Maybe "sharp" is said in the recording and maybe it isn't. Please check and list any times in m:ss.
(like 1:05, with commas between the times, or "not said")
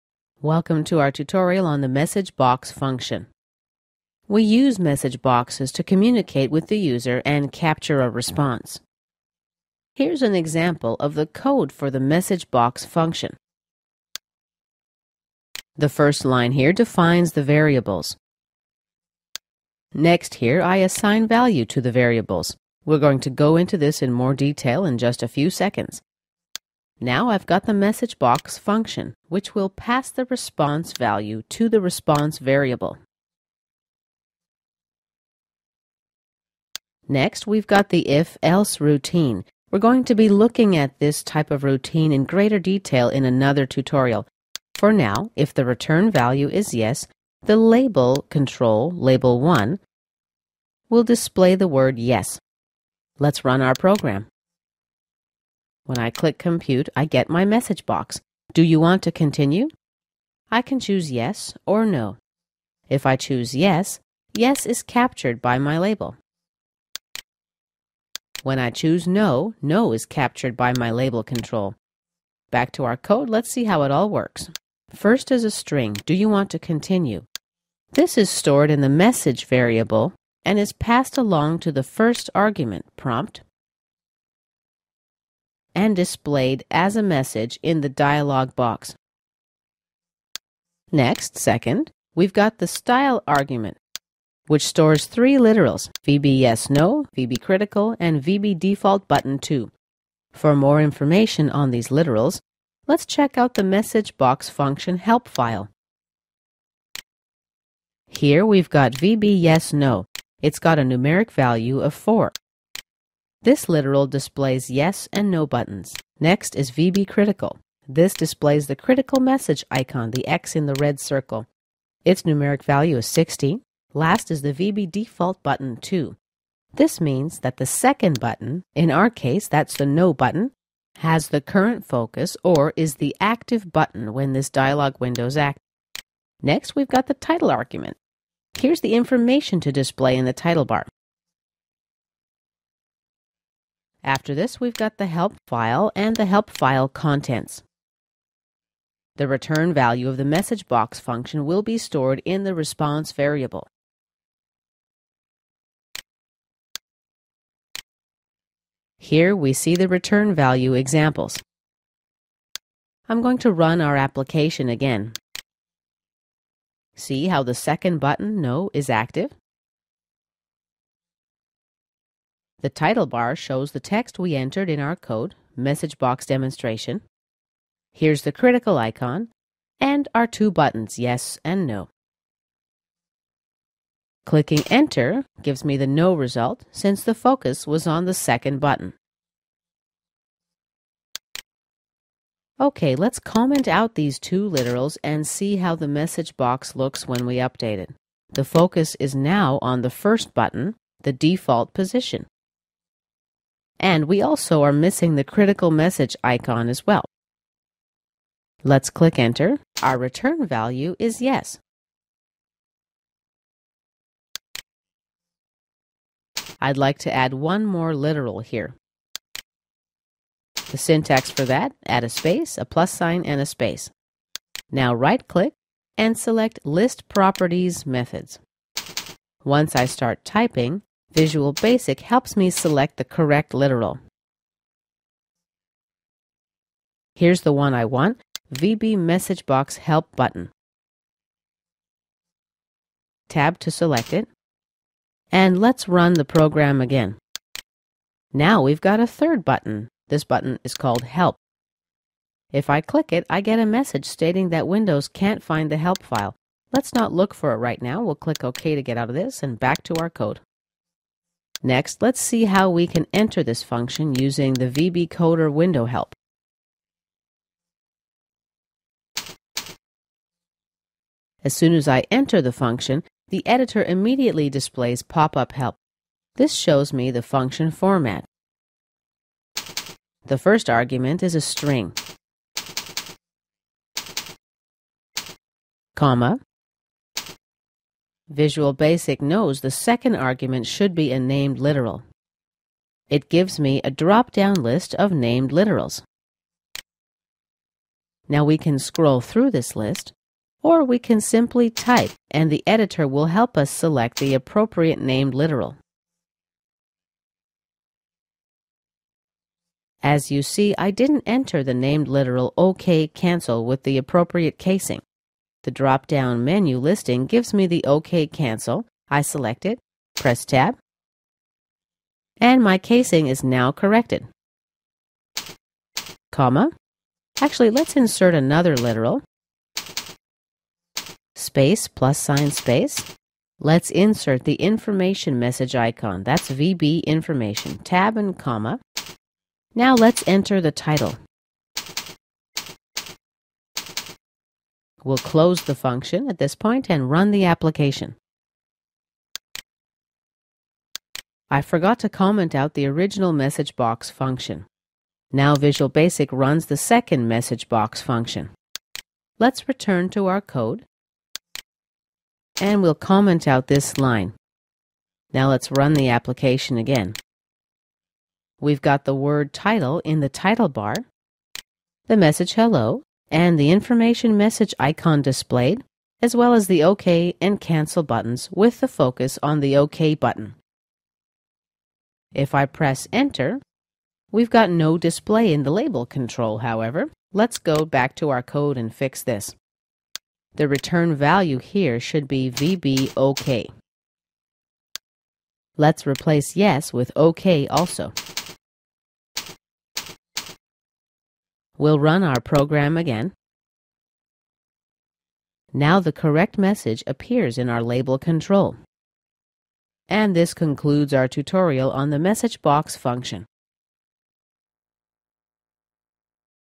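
not said.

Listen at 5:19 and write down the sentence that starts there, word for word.
I select it, press tab, and my casing is now corrected.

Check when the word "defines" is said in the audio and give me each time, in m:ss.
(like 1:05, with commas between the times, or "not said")
0:16.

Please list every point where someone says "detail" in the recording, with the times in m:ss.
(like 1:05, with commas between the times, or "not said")
0:24, 0:42.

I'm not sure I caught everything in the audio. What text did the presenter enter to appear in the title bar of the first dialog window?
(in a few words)
message box demonstration.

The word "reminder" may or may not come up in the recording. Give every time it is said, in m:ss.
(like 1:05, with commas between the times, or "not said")
not said.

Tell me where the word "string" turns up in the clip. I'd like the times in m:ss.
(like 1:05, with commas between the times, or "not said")
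1:15, 4:41.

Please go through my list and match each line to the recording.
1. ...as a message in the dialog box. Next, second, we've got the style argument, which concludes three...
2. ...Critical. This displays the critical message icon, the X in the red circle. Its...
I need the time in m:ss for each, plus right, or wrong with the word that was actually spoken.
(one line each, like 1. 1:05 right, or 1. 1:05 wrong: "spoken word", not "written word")
1. 1:26 wrong: "stores", not "concludes"
2. 1:57 right.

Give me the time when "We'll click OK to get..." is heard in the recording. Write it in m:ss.
4:18.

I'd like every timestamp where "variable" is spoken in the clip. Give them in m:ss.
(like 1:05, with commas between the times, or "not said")
0:17, 0:21, 0:32, 1:19, 2:33.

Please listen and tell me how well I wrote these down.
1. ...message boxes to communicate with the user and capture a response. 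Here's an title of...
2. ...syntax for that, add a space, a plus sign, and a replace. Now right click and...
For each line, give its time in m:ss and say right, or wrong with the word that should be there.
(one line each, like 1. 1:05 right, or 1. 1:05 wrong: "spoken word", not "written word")
1. 0:04 wrong: "example", not "title"
2. 3:40 wrong: "space", not "replace".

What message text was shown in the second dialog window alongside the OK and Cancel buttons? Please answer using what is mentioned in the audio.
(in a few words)
hello.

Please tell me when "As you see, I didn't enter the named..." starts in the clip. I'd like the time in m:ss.
5:10.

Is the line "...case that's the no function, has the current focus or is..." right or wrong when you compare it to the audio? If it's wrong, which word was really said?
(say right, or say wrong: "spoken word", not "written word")
wrong: "button", not "function".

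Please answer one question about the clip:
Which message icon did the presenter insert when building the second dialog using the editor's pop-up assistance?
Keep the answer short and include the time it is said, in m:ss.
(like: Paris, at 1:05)
VB information, at 5:36.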